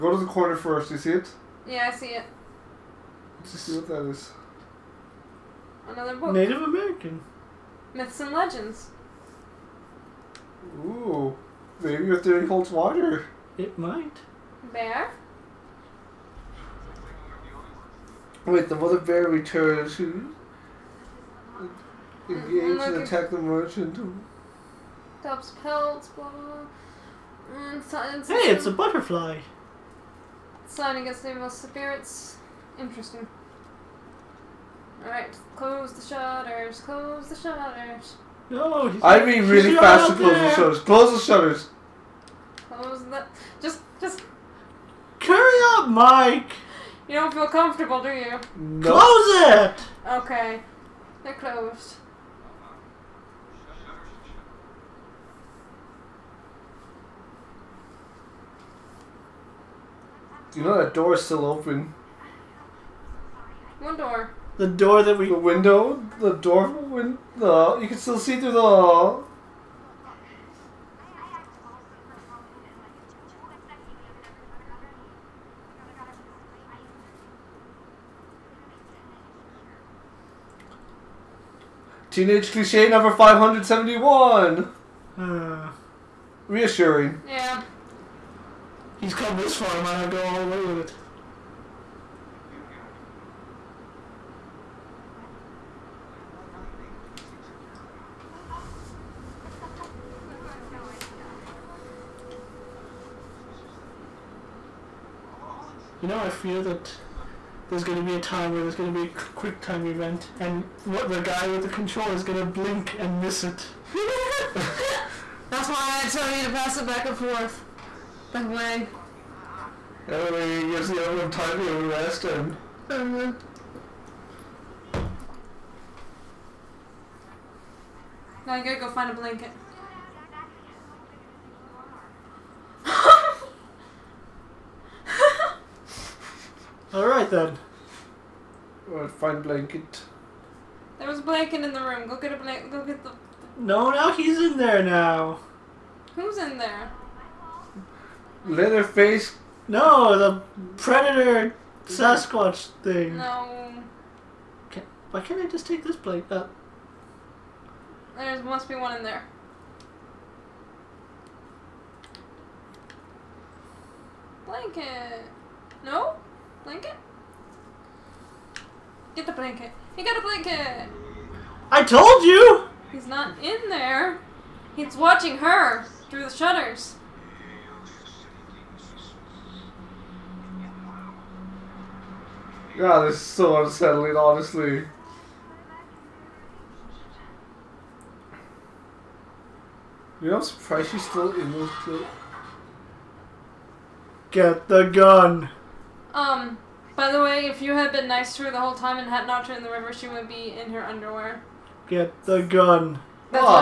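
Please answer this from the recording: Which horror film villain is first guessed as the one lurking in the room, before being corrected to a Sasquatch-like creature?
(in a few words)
Leatherface.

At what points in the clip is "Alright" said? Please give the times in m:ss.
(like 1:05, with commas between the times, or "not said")
0:35, 2:16.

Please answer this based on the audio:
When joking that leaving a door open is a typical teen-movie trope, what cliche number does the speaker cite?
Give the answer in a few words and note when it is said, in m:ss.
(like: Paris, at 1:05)
571, at 1:23.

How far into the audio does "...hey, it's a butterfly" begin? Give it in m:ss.
0:28.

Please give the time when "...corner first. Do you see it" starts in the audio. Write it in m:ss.
0:00.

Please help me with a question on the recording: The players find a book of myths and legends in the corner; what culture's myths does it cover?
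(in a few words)
Native American.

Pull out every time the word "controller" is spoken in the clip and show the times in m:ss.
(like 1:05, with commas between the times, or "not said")
1:51.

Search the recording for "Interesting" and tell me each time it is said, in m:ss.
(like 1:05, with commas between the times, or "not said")
0:32.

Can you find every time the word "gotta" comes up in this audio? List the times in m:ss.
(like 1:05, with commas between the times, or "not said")
2:08.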